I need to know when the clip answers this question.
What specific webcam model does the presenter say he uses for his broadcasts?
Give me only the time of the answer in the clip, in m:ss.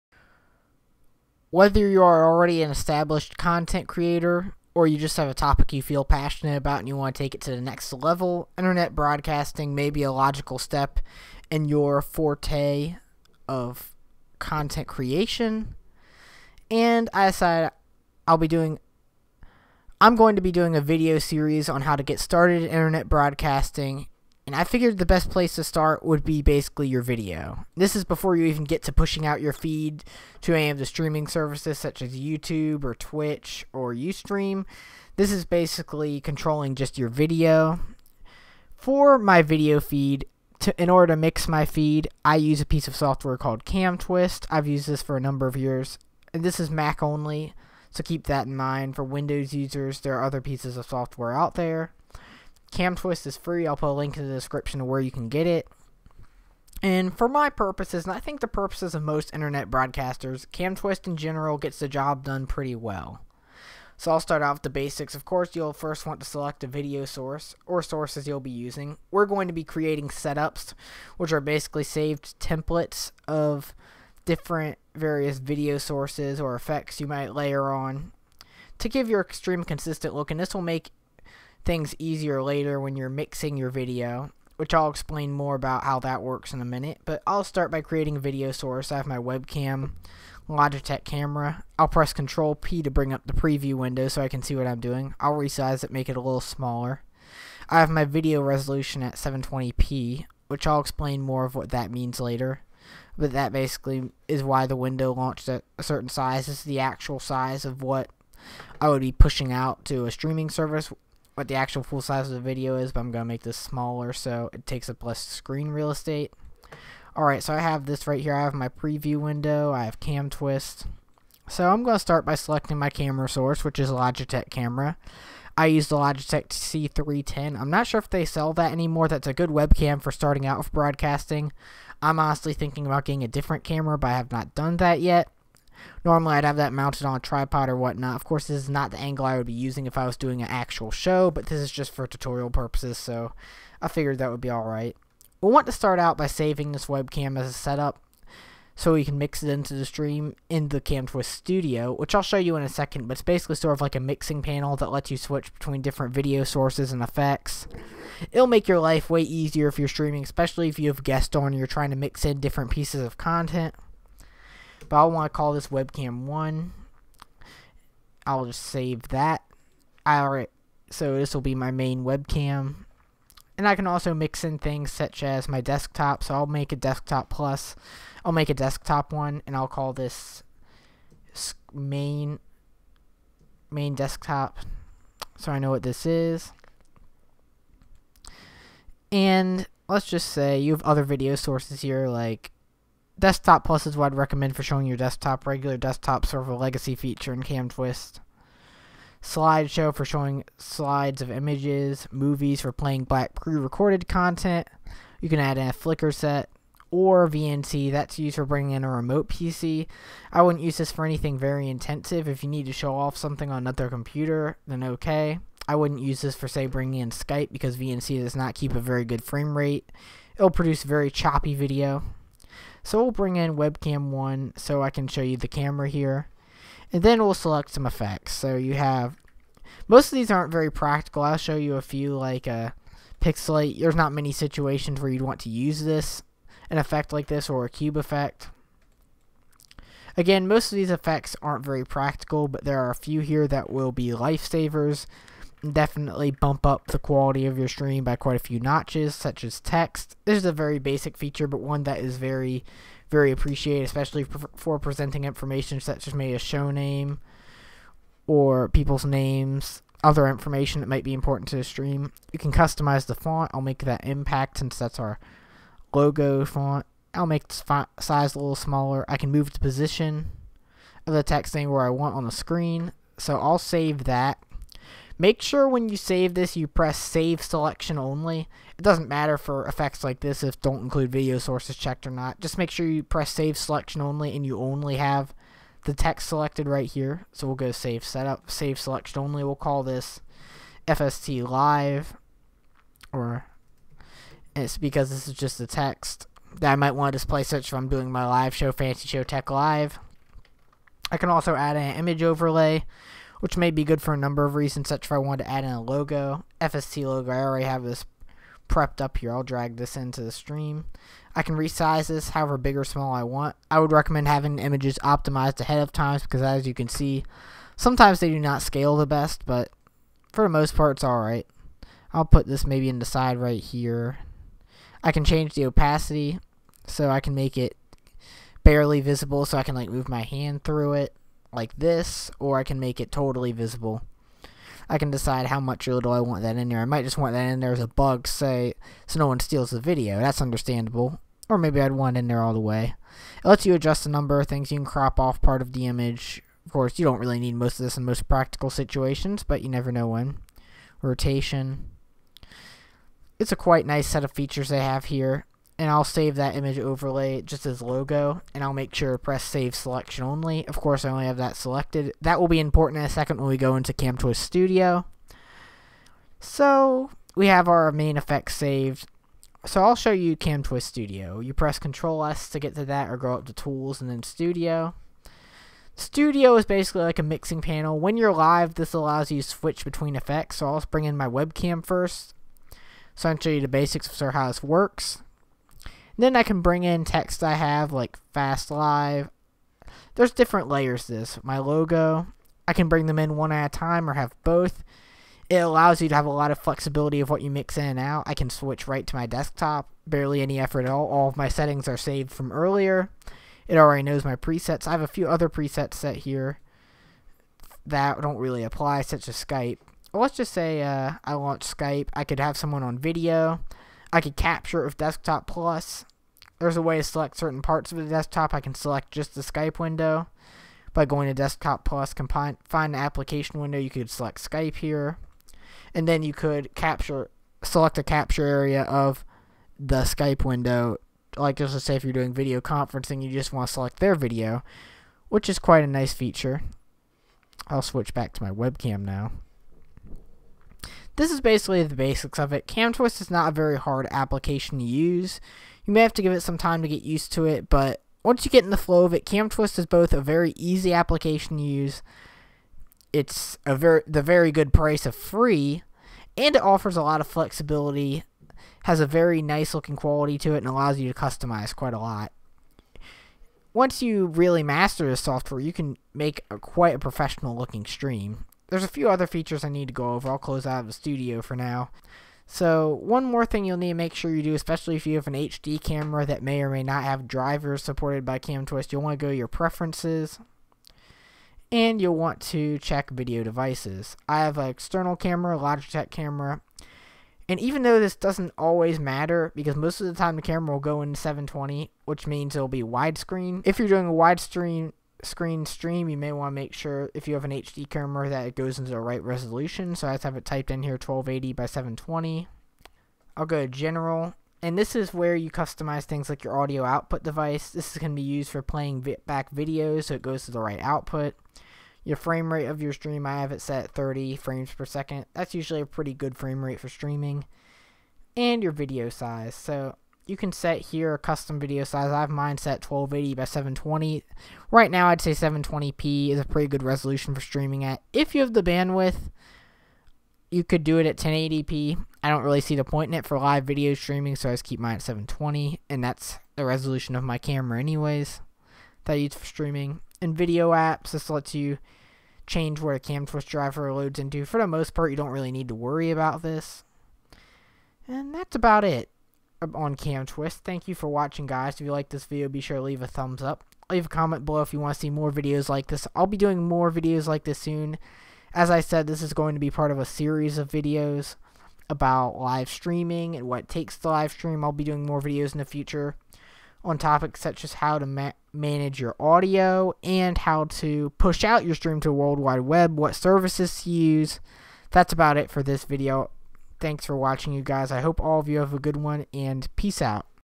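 2:05.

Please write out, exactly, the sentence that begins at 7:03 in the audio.
You could select Skype here, and then you could capture, select a capture area of the Skype window.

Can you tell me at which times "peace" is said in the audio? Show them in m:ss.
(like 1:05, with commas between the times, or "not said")
9:39.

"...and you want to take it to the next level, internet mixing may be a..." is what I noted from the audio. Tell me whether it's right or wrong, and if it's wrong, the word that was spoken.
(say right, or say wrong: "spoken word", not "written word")
wrong: "broadcasting", not "mixing".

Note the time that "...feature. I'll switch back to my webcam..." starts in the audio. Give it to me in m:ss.
7:16.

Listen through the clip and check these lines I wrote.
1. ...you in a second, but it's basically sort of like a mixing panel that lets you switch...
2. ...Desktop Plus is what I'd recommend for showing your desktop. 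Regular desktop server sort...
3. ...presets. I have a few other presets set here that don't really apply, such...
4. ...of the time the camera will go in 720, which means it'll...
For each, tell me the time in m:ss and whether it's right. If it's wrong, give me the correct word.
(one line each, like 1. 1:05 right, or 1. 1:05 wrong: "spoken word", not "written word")
1. 2:32 right
2. 3:13 right
3. 6:44 right
4. 8:10 right.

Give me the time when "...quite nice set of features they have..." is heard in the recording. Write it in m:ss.
5:53.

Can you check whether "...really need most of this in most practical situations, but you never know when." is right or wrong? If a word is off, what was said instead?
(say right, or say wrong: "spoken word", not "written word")
right.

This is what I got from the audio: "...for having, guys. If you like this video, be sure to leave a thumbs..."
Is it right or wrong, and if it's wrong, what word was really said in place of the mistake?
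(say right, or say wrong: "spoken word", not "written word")
wrong: "watching", not "having".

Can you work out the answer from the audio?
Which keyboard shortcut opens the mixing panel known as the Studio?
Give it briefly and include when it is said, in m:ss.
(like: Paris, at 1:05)
Control S, at 6:11.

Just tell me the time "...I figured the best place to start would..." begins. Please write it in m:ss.
0:24.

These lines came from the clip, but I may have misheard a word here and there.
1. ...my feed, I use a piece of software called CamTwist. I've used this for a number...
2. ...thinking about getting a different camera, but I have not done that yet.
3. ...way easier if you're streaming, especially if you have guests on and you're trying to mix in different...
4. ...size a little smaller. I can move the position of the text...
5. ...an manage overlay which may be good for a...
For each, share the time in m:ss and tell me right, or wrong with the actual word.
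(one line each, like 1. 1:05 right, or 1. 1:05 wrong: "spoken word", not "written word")
1. 0:41 right
2. 2:12 right
3. 2:39 right
4. 4:27 right
5. 5:01 wrong: "image", not "manage".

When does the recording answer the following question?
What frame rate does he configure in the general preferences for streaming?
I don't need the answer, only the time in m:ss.
8:33.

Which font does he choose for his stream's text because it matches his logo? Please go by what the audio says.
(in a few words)
Impact.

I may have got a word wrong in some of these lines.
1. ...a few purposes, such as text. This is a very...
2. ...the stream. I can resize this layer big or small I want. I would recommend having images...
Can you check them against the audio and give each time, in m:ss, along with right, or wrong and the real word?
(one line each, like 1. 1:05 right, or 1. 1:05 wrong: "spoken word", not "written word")
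1. 4:08 wrong: "notches", not "purposes"
2. 5:10 wrong: "however", not "layer".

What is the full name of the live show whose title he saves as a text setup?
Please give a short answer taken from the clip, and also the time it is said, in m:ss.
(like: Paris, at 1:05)
Fancy Show Tech Live, at 4:58.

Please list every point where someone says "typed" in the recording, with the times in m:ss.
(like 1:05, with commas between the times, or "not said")
8:20.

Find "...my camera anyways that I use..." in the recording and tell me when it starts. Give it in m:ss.
8:57.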